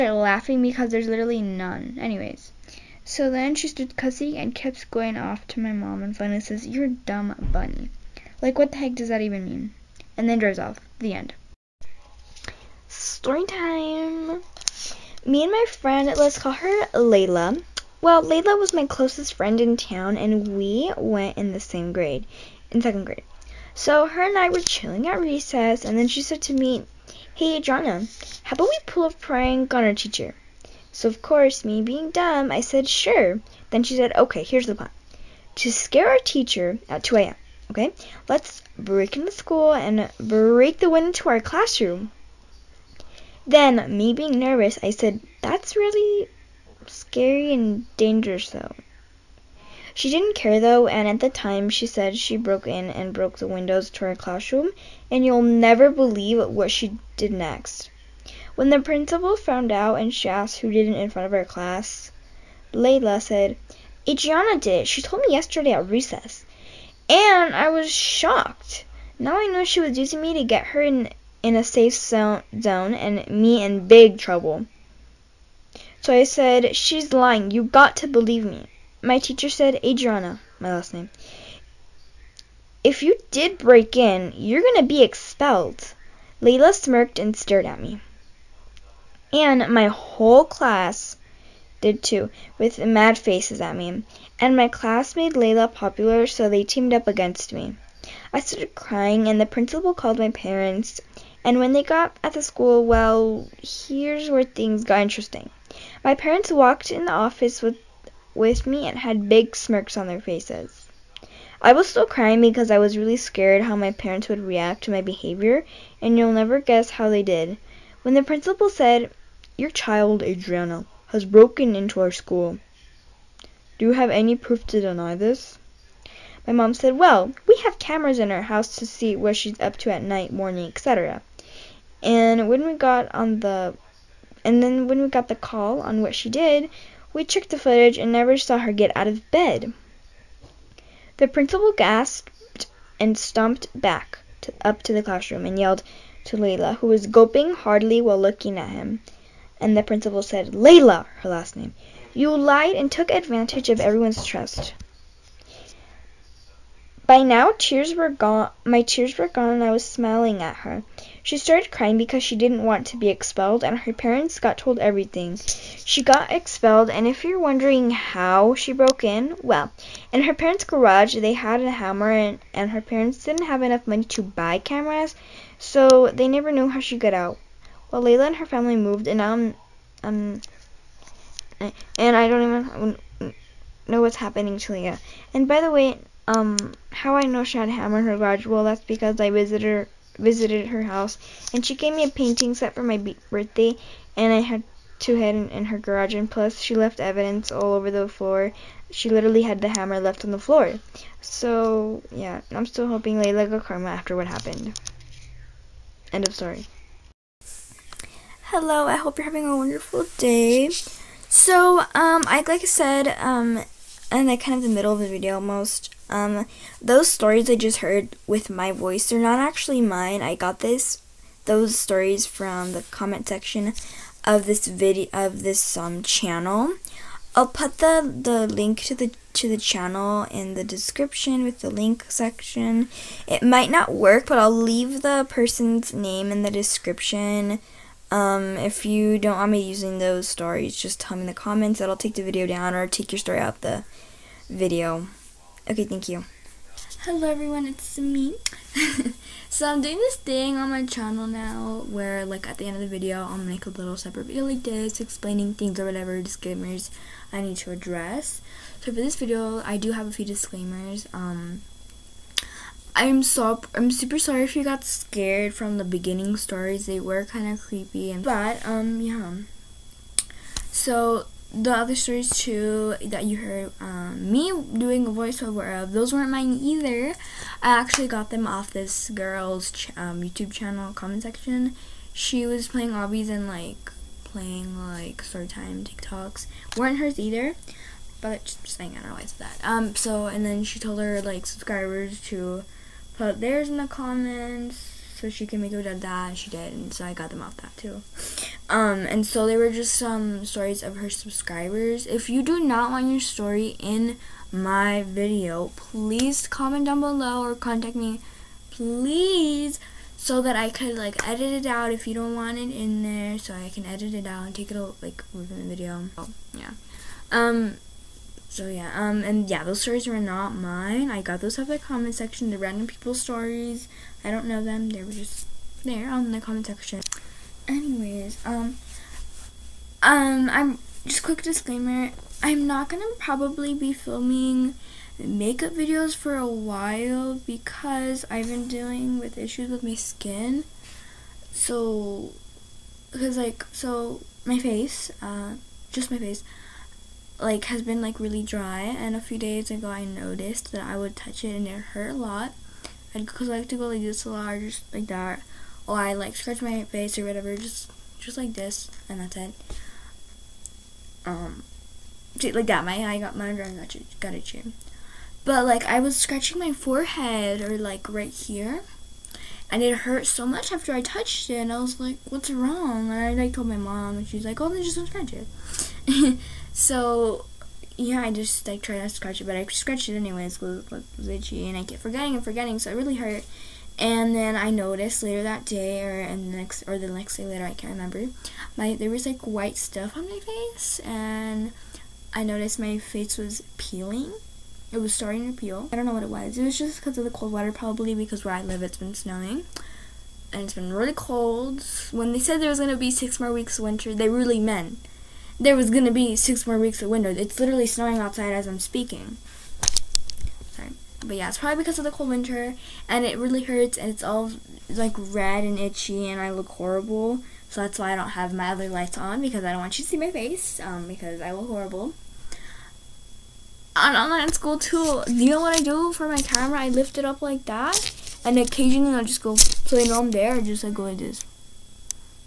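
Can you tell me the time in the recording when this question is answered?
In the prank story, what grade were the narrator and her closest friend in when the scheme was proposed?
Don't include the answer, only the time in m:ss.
0:22.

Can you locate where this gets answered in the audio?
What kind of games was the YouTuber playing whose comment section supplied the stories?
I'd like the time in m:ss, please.
4:42.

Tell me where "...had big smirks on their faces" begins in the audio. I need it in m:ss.
1:48.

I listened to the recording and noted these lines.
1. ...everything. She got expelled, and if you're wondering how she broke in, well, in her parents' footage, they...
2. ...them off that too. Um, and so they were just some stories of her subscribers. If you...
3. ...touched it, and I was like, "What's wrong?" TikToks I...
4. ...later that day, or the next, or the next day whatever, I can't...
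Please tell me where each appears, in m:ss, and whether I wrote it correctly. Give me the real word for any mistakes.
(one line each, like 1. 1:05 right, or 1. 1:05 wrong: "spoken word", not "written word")
1. 2:44 wrong: "garage", not "footage"
2. 4:57 right
3. 6:11 wrong: "And", not "TikToks"
4. 6:25 wrong: "later", not "whatever".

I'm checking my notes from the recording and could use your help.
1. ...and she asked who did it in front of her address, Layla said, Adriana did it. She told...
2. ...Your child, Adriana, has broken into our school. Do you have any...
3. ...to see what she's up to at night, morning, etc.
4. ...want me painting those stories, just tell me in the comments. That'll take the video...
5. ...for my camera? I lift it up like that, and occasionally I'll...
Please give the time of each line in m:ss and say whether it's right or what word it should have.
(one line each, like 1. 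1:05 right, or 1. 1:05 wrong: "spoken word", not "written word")
1. 0:59 wrong: "class", not "address"
2. 1:59 right
3. 2:08 right
4. 3:59 wrong: "using", not "painting"
5. 7:06 right.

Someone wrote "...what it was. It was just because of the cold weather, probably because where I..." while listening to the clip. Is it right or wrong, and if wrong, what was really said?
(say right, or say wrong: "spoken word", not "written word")
right.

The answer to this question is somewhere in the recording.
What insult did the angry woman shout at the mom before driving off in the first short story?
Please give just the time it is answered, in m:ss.
0:06.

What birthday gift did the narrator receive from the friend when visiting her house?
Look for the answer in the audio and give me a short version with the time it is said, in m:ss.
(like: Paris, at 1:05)
a painting set, at 3:12.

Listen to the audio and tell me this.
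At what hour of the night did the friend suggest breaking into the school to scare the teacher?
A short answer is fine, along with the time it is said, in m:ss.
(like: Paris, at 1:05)
2 a.m., at 0:37.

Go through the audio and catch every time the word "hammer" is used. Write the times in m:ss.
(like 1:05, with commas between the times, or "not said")
2:51, 3:07, 3:19.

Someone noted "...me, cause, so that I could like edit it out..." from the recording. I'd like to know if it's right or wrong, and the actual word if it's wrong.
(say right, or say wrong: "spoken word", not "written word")
wrong: "please", not "cause".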